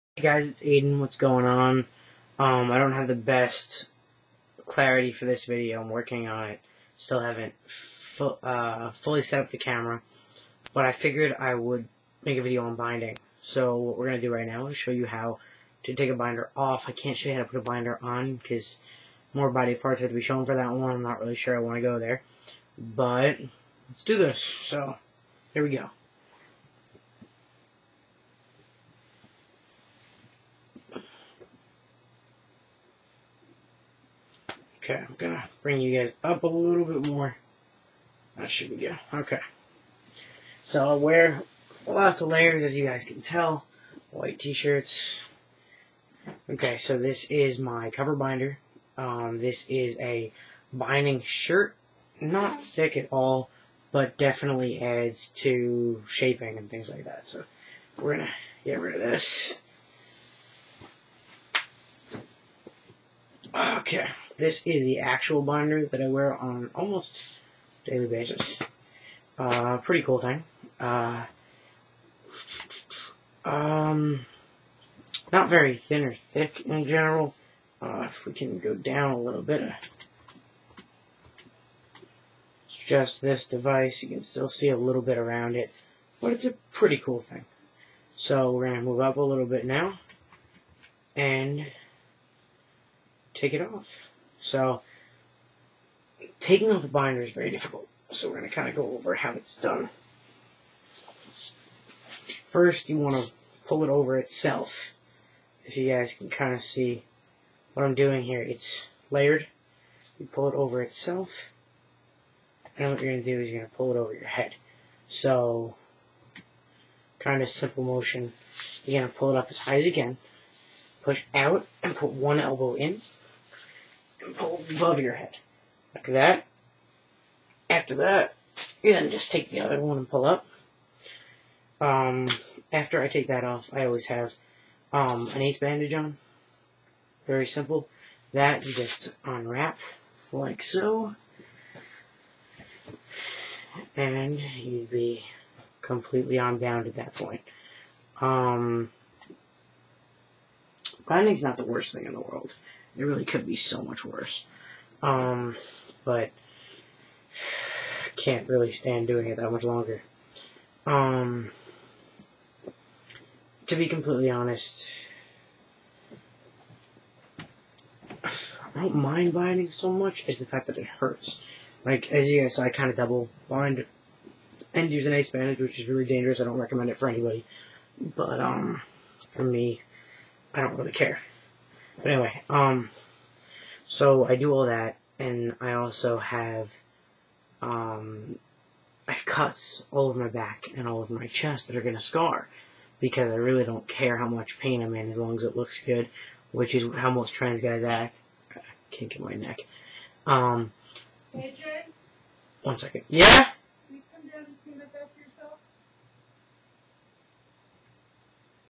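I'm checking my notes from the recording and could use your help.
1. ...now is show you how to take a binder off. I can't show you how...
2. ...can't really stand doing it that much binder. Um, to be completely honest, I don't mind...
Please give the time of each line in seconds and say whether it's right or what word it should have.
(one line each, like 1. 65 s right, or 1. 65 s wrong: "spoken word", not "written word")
1. 14 s right
2. 158 s wrong: "longer", not "binder".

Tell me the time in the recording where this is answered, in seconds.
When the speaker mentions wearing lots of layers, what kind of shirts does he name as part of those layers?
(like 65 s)
44 s.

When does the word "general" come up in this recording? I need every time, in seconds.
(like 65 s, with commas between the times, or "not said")
76 s.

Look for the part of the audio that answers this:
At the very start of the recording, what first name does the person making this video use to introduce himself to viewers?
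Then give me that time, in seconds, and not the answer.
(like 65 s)
0 s.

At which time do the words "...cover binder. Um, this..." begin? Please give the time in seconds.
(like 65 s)
47 s.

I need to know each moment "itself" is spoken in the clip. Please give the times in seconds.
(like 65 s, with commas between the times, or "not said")
104 s, 110 s.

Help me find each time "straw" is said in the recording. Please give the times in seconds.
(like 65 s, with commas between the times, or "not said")
not said.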